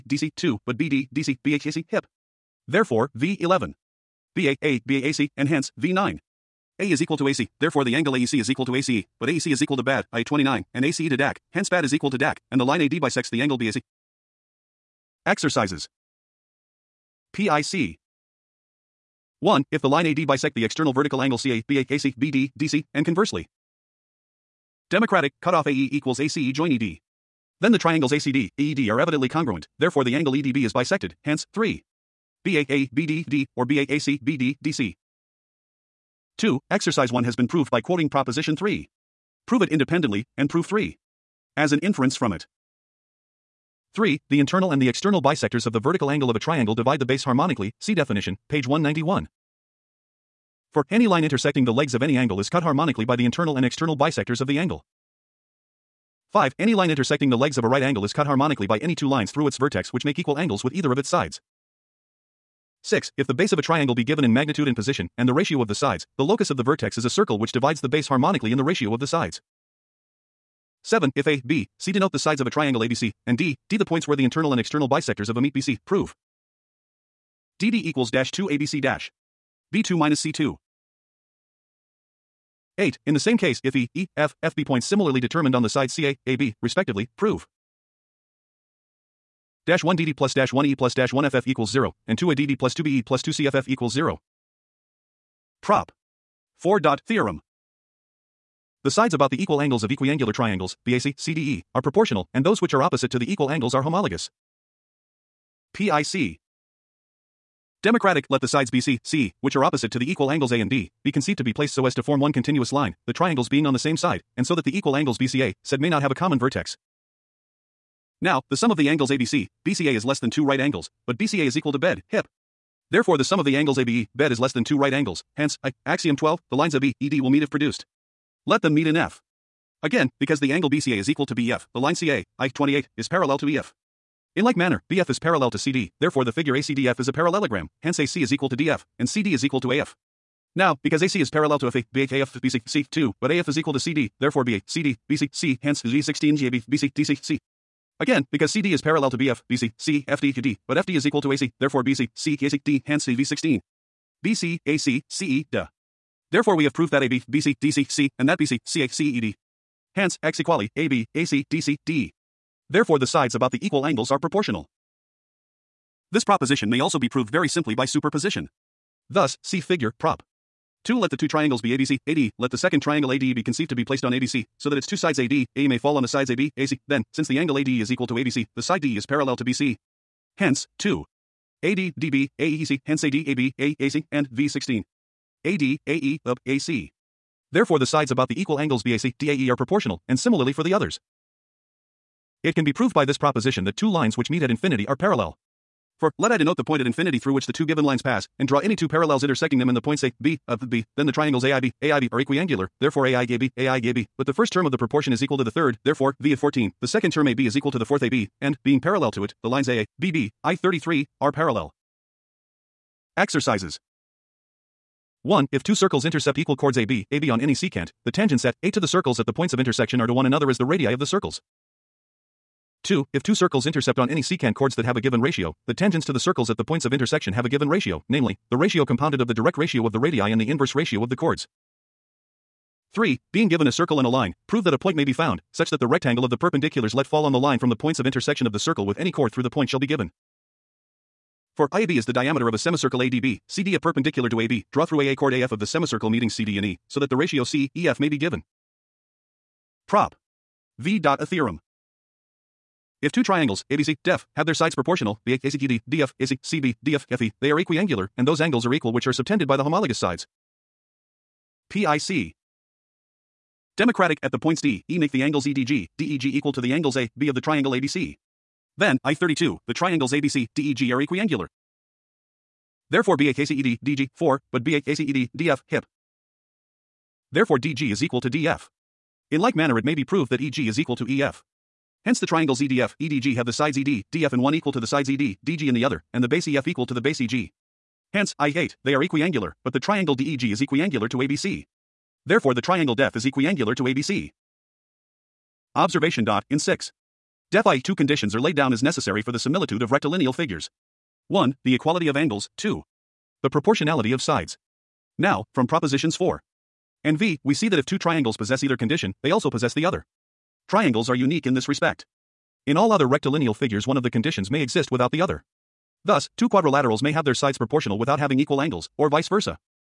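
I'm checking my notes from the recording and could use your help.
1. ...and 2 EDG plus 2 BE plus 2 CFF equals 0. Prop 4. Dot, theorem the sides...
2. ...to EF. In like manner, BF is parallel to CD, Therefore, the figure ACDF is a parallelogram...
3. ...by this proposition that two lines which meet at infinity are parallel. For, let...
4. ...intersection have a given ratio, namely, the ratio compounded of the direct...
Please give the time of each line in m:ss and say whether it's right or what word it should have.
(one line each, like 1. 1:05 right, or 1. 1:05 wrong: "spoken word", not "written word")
1. 1:32 wrong: "ADD", not "EDG"
2. 2:13 right
3. 3:12 right
4. 3:46 right.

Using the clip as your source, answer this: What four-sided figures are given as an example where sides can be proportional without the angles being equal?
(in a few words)
quadrilaterals.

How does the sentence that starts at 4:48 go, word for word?
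Hence, I8, they are equiangular, but the triangle DEG is equiangular to ABC.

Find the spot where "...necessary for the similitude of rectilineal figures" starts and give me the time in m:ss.
4:58.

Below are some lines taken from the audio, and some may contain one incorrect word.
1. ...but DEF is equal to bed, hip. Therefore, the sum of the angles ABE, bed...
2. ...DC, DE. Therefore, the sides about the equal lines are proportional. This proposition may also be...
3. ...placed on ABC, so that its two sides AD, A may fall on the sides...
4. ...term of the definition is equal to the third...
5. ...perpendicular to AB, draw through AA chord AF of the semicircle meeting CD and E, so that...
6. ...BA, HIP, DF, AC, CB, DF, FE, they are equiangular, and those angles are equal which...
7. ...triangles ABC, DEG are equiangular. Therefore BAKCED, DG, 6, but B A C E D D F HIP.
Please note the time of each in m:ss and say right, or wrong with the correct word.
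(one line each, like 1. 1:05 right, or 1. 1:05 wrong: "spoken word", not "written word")
1. 2:01 wrong: "BCA", not "DEF"
2. 2:41 wrong: "angles", not "lines"
3. 2:53 right
4. 3:24 wrong: "proportion", not "definition"
5. 4:03 right
6. 4:15 wrong: "ACGD", not "HIP"
7. 4:29 wrong: "4", not "6".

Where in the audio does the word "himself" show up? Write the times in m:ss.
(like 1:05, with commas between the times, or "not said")
not said.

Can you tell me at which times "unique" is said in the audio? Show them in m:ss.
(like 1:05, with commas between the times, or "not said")
5:11.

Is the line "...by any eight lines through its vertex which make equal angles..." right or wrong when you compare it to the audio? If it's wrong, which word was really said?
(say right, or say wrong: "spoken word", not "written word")
wrong: "two", not "eight".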